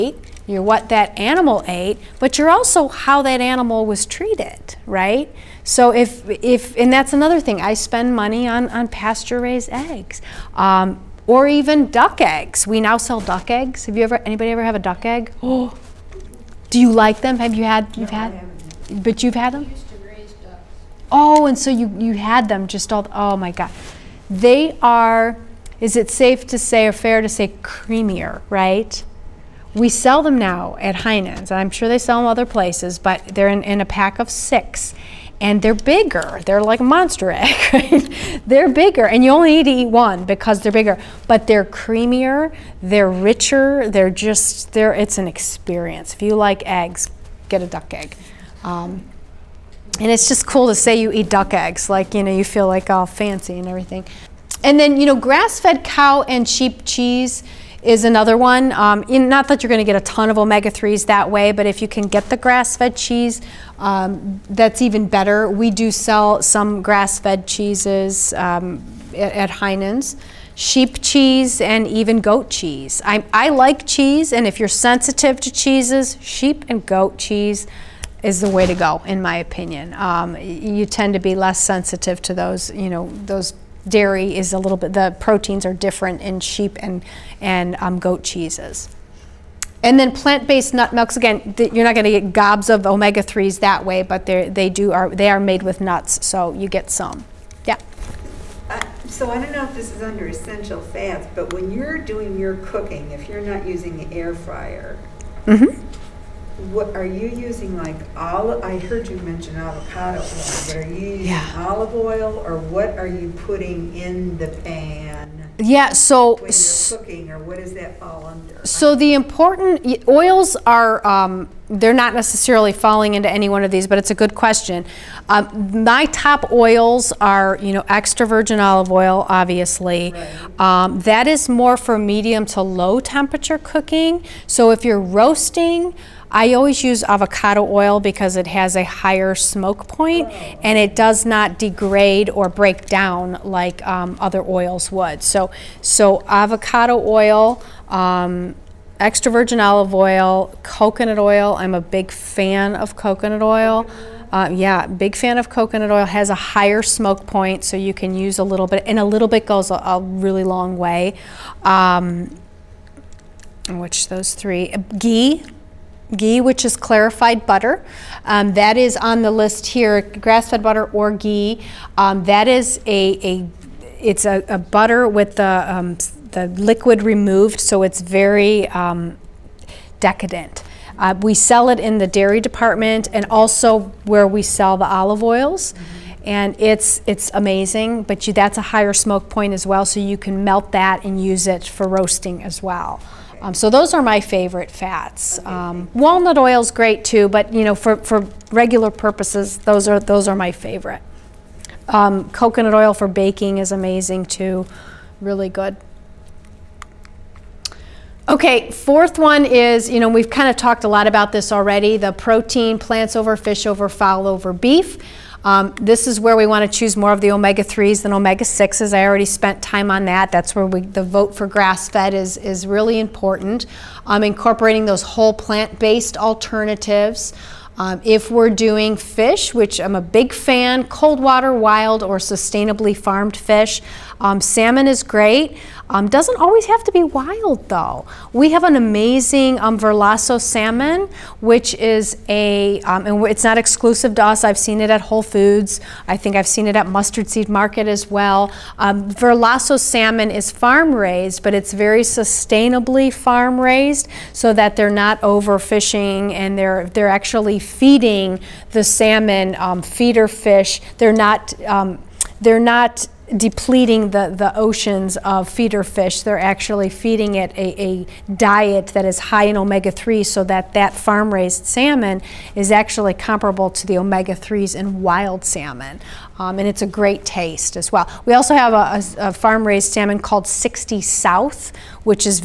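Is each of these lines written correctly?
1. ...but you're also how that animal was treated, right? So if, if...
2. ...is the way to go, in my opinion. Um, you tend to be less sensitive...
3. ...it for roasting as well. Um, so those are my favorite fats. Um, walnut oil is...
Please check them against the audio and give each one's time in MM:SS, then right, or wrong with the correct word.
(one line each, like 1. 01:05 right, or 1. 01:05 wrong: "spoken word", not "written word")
1. 00:02 right
2. 01:18 right
3. 03:11 right.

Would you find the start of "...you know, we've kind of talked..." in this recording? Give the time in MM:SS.
03:29.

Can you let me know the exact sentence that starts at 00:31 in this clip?
I'm sure they sell them other places, but they're in, in a pack of six and they're bigger.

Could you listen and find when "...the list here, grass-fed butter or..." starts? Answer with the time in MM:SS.
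02:49.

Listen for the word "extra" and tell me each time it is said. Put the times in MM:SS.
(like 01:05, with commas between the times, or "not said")
02:07, 02:28.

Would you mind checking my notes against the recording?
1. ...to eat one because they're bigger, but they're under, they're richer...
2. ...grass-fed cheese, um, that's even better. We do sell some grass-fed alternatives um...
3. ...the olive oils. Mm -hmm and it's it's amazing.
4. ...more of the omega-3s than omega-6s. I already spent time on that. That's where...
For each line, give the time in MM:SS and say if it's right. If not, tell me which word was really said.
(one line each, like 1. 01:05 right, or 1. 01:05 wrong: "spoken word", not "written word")
1. 00:39 wrong: "creamier", not "under"
2. 01:02 wrong: "cheeses", not "alternatives"
3. 03:04 right
4. 03:36 right.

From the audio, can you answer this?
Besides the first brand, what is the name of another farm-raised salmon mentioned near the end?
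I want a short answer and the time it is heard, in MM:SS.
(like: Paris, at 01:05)
60 South, at 04:40.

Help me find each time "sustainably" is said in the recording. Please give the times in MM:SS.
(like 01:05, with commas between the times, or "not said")
03:52, 04:12.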